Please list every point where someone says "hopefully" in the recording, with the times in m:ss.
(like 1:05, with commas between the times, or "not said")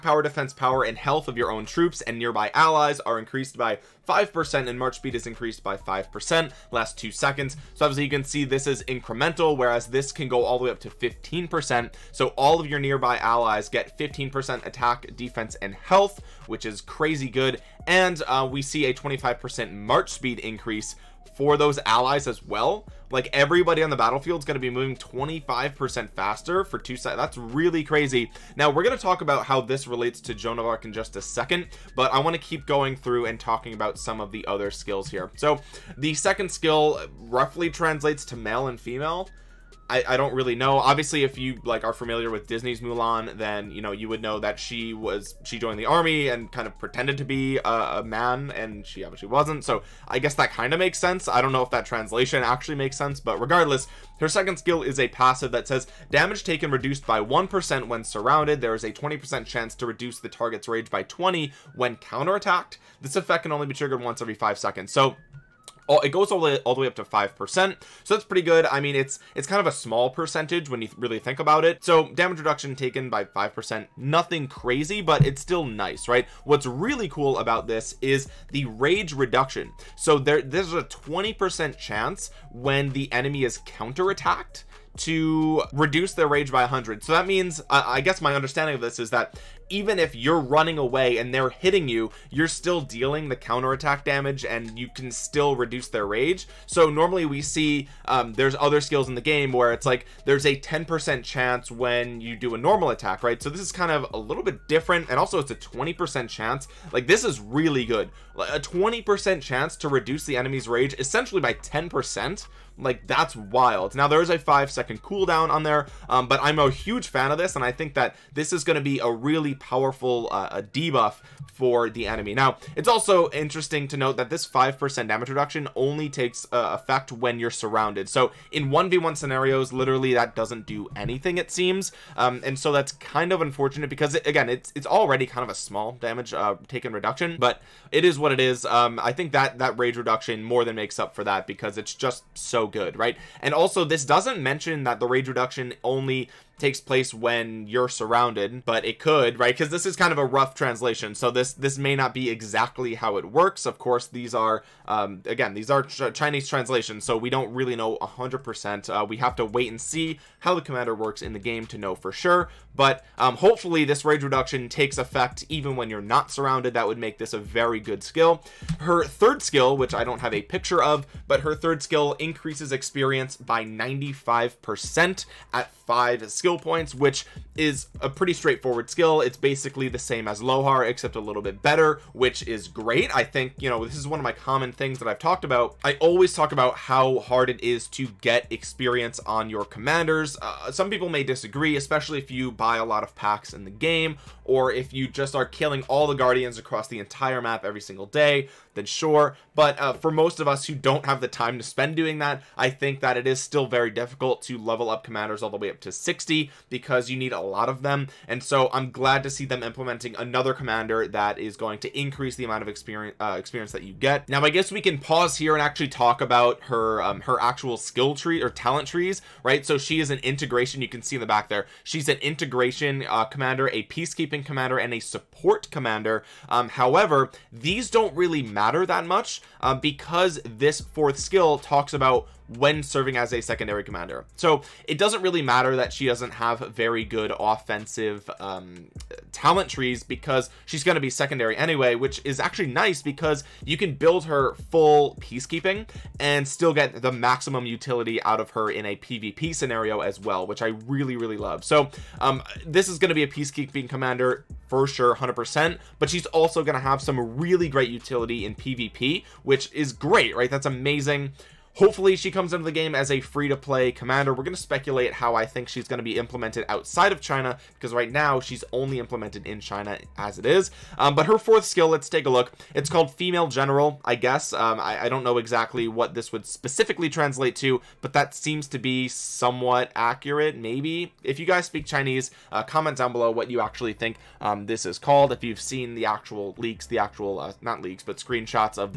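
2:43, 4:21.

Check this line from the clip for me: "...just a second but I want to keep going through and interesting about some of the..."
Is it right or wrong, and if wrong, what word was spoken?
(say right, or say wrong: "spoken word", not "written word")
wrong: "talking", not "interesting".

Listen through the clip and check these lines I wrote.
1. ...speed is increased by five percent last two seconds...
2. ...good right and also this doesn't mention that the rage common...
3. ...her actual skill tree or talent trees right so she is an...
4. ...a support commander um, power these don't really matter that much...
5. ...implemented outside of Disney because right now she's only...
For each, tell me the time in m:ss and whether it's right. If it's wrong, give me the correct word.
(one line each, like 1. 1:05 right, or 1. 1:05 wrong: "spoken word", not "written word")
1. 0:04 right
2. 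2:22 wrong: "reduction", not "common"
3. 3:37 right
4. 3:44 wrong: "however", not "power"
5. 4:26 wrong: "China", not "Disney".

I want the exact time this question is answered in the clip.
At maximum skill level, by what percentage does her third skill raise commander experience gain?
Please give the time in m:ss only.
2:53.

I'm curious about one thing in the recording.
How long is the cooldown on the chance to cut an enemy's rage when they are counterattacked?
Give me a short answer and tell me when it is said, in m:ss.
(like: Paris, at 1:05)
5 seconds, at 1:54.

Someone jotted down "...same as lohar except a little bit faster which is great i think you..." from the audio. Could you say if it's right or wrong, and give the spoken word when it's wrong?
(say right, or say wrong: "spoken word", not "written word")
wrong: "better", not "faster".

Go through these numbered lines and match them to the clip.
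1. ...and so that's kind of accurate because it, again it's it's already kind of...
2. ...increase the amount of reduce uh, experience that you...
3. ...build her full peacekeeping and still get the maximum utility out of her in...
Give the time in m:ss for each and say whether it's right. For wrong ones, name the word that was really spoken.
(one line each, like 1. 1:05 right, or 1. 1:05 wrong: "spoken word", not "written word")
1. 2:12 wrong: "unfortunate", not "accurate"
2. 3:31 wrong: "experience", not "reduce"
3. 4:03 right.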